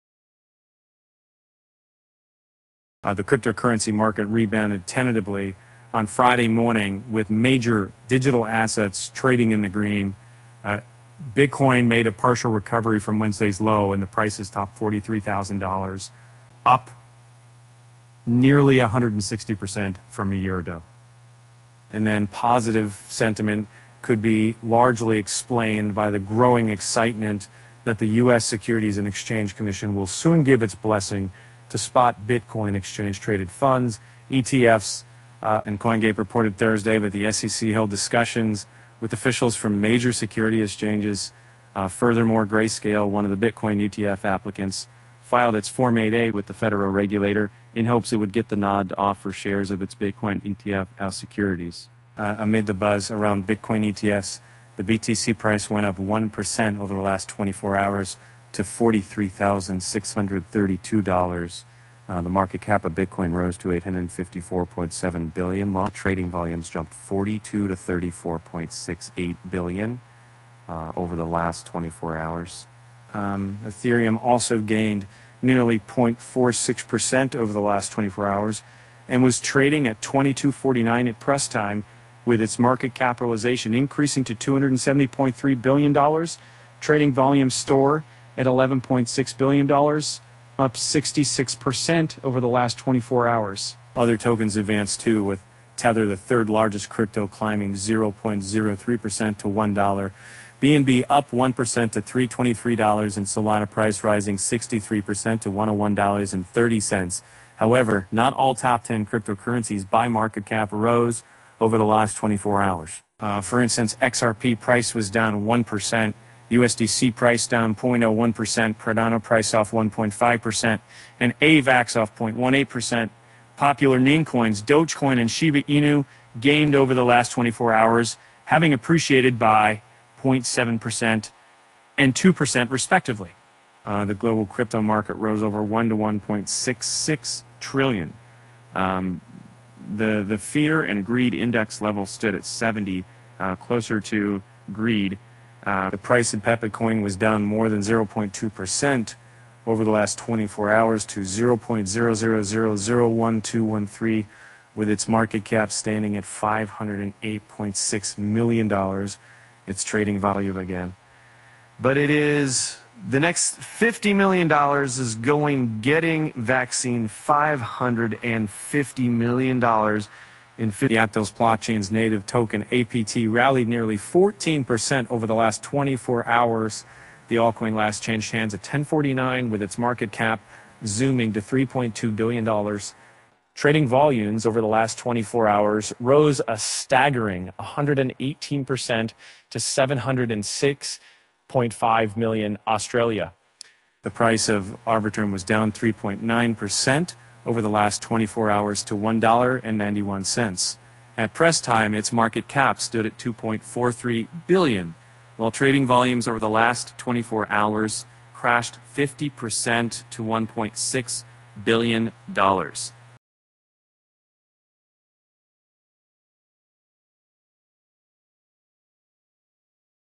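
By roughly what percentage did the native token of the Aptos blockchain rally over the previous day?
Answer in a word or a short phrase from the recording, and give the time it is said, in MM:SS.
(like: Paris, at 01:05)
14%, at 02:53.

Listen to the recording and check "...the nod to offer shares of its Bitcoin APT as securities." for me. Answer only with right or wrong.
wrong.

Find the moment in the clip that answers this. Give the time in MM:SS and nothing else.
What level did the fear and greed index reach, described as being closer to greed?
02:22.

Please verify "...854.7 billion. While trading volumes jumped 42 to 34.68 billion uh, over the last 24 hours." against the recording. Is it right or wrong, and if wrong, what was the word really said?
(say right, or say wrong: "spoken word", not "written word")
right.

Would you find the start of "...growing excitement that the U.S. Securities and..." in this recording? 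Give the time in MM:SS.
00:26.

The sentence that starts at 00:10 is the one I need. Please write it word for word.
Uh, Bitcoin made a partial recovery from Wednesday's low, and the prices topped $43,000, up nearly 160% from a year ago.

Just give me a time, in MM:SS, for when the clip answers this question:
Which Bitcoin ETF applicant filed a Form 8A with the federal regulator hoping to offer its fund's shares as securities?
00:42.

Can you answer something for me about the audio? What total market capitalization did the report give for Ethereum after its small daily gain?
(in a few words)
$270.3 billion.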